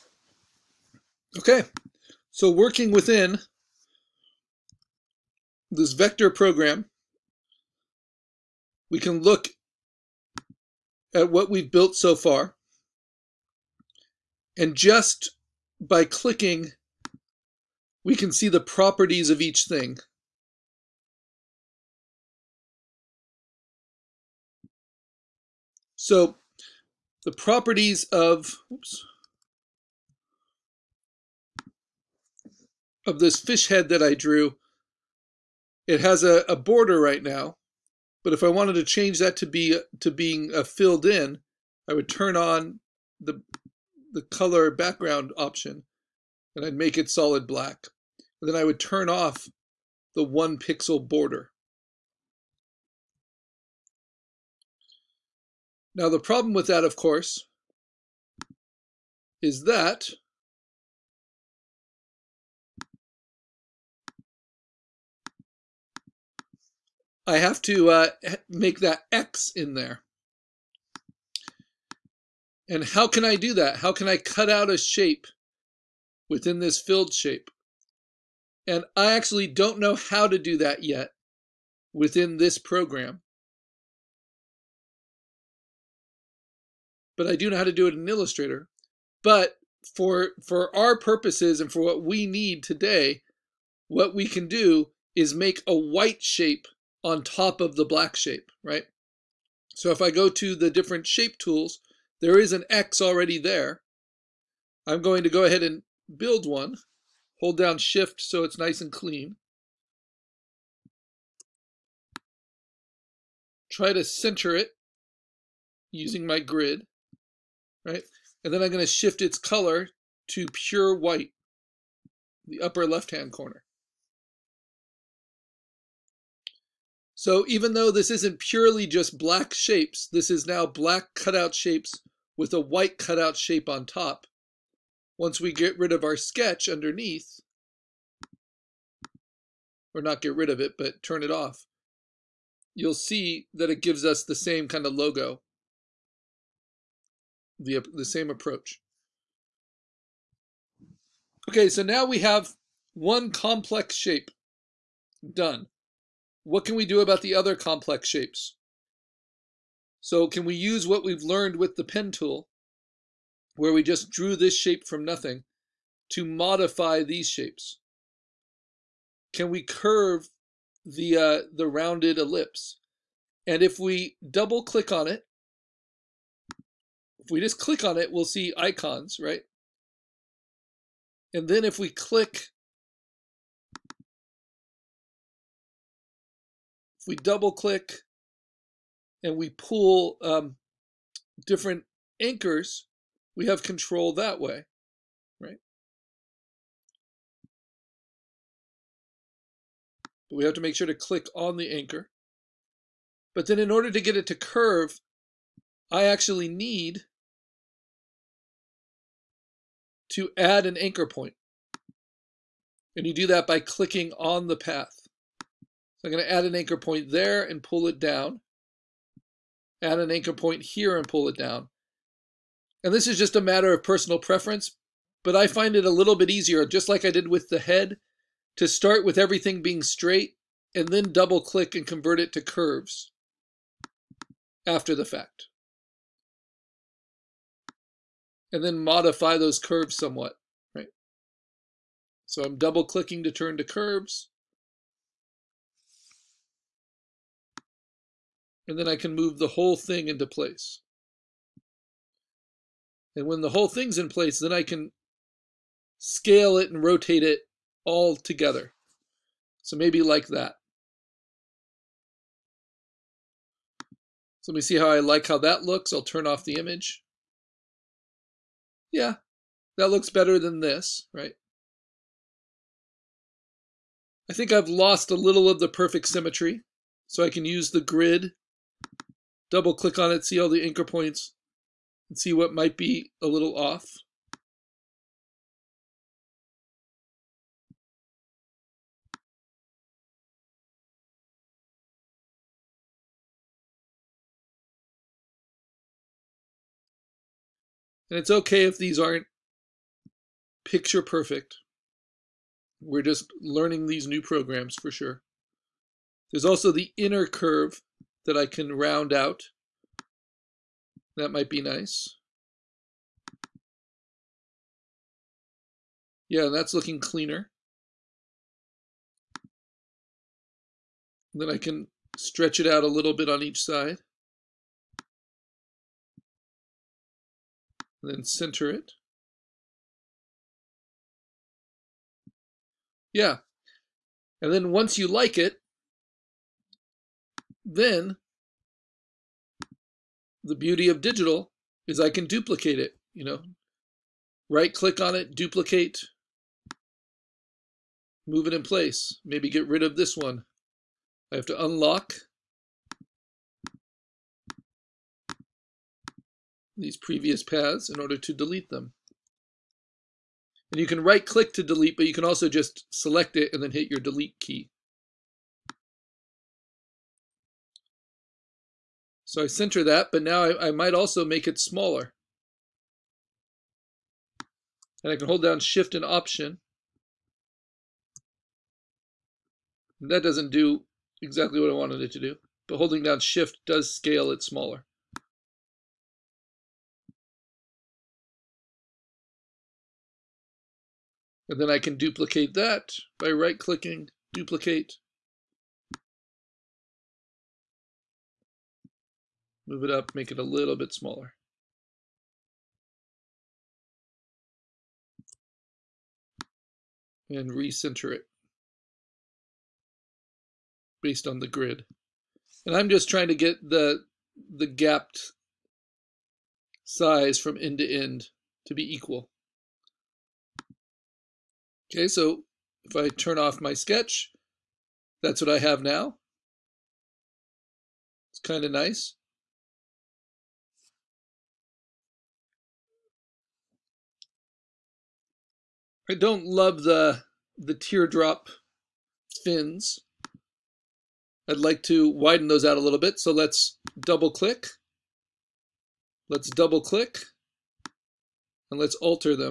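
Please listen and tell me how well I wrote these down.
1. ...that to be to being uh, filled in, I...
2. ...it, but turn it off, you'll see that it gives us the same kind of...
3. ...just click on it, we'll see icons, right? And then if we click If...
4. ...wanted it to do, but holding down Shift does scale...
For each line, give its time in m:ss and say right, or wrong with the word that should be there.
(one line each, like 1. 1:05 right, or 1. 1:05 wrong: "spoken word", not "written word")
1. 0:39 right
2. 2:20 right
3. 2:57 right
4. 6:21 right.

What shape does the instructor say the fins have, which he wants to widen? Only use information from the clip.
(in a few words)
teardrop.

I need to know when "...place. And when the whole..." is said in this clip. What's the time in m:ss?
4:10.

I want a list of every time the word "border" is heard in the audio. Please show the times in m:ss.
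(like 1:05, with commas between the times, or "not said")
0:36, 0:51.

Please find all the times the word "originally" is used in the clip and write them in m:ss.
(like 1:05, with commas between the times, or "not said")
not said.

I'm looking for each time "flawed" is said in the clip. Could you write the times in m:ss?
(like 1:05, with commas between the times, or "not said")
not said.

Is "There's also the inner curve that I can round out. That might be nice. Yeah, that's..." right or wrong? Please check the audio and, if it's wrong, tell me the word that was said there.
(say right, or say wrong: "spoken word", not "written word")
right.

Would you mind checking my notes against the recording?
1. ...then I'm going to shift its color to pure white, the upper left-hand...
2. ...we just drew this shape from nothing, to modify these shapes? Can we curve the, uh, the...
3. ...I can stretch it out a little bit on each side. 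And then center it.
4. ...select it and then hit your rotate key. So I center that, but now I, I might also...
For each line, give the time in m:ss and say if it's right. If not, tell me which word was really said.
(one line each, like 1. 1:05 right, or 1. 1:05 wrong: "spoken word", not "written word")
1. 1:58 right
2. 2:43 right
3. 5:21 right
4. 6:02 wrong: "delete", not "rotate".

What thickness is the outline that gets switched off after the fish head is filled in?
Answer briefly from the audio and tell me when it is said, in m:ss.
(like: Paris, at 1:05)
1 pixel, at 0:50.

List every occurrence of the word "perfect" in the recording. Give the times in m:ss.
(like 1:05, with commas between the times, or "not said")
4:35, 5:01.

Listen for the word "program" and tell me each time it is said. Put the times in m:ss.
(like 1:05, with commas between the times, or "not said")
0:06, 1:22, 5:04.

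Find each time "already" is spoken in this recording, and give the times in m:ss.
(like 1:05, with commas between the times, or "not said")
1:43.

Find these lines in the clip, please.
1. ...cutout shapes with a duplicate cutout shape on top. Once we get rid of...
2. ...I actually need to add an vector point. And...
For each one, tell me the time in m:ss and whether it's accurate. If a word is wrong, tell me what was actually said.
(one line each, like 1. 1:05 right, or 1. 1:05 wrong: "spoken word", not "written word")
1. 2:11 wrong: "white", not "duplicate"
2. 3:25 wrong: "anchor", not "vector".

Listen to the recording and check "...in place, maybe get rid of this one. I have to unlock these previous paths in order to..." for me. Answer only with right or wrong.
right.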